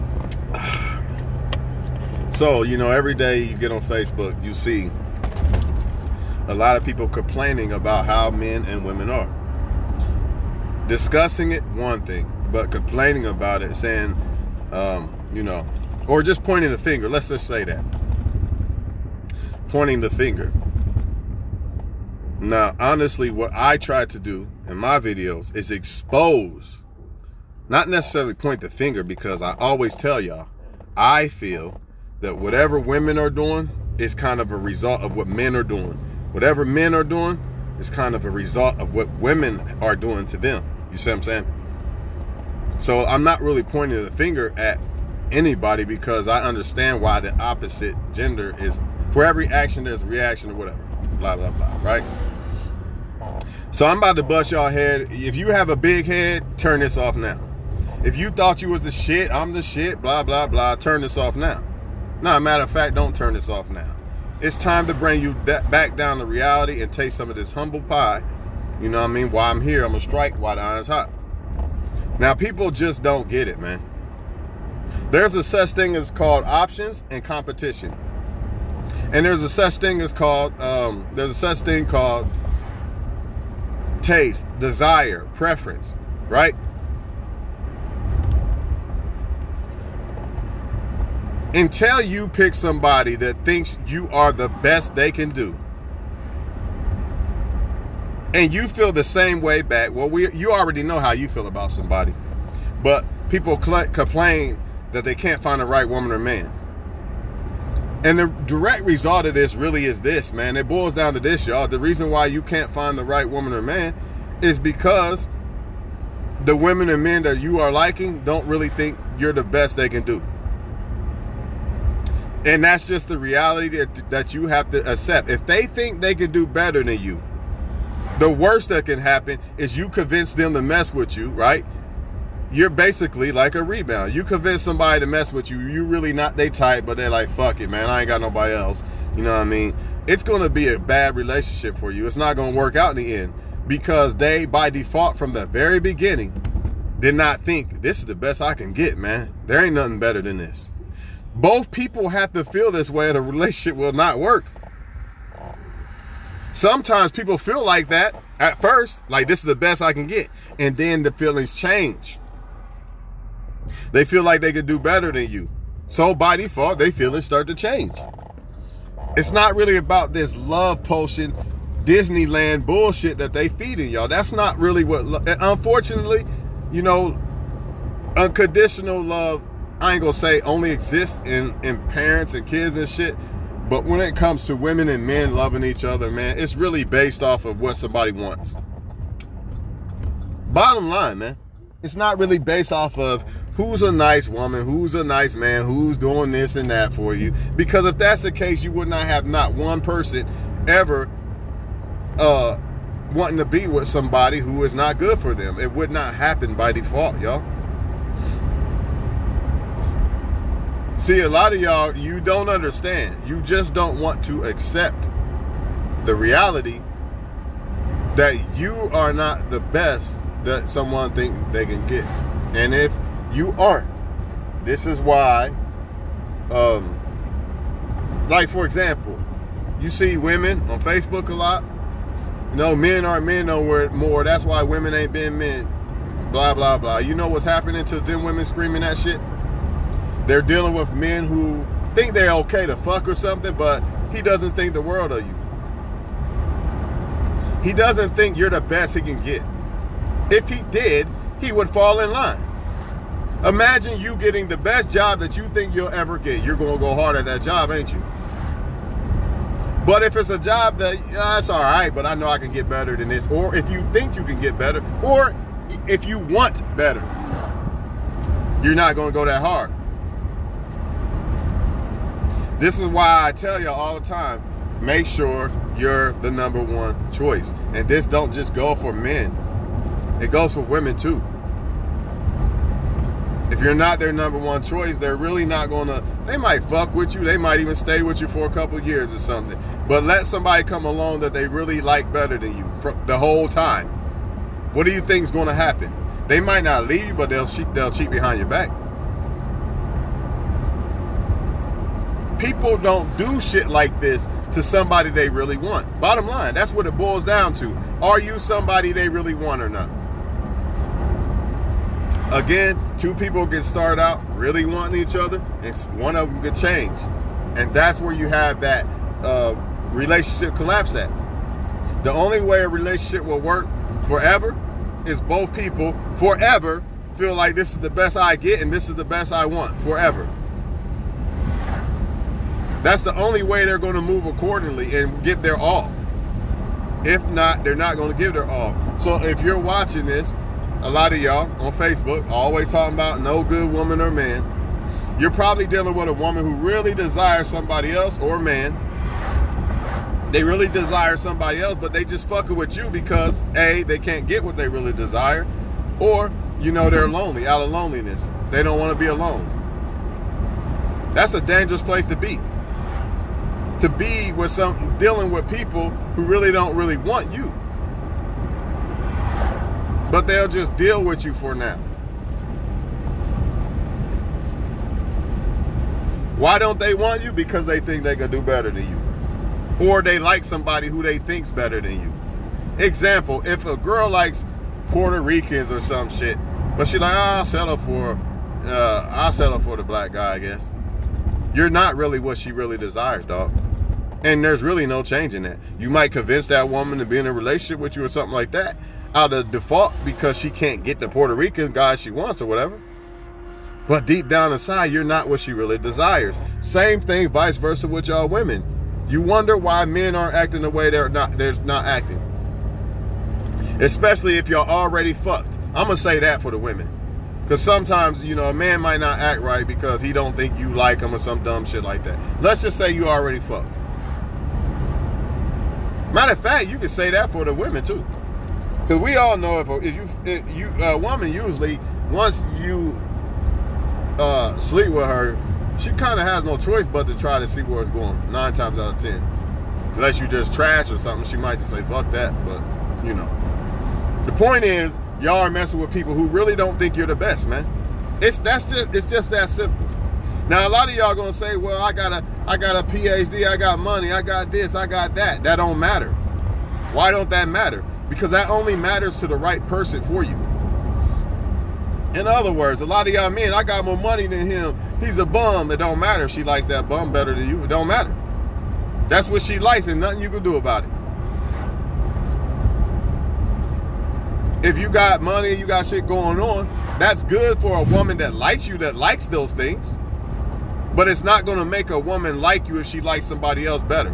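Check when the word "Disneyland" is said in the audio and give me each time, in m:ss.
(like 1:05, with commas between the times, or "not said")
2:51.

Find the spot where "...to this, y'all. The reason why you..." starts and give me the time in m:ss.
1:51.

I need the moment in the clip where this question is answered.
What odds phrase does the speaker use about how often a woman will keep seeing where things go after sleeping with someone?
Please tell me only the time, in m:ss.
7:18.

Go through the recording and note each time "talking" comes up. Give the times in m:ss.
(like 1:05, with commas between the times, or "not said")
5:42.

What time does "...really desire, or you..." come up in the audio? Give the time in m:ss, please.
5:54.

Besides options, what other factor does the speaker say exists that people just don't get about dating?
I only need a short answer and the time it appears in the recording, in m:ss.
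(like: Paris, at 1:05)
competition, at 1:17.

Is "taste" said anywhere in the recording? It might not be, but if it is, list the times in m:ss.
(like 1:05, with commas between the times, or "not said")
1:06, 1:24.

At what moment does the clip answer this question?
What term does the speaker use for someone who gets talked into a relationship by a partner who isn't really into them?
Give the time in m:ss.
2:13.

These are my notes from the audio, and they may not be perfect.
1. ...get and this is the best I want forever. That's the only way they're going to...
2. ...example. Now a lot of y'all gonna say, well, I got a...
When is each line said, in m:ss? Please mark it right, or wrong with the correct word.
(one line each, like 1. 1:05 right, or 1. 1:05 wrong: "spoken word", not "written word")
1. 5:28 right
2. 7:29 wrong: "simple", not "example".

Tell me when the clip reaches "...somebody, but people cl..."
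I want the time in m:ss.
1:41.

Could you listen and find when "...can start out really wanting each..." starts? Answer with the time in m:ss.
5:13.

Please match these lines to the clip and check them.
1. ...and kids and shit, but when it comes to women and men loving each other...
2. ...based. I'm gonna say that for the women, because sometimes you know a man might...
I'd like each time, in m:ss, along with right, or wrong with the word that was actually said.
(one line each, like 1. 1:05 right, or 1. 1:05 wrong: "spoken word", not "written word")
1. 3:02 right
2. 6:55 wrong: "fucked", not "based".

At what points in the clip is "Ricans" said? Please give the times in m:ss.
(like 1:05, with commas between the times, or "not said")
6:25, 6:41.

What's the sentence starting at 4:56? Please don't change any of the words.
They might not leave you, but they'll cheat, they'll cheat behind your back.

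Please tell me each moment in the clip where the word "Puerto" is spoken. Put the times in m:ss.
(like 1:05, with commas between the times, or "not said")
6:24, 6:41.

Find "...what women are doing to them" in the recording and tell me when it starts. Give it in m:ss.
0:38.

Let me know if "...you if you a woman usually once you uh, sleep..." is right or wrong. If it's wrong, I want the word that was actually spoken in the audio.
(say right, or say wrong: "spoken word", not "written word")
right.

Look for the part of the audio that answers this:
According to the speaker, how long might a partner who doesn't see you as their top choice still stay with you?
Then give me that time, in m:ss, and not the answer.
4:48.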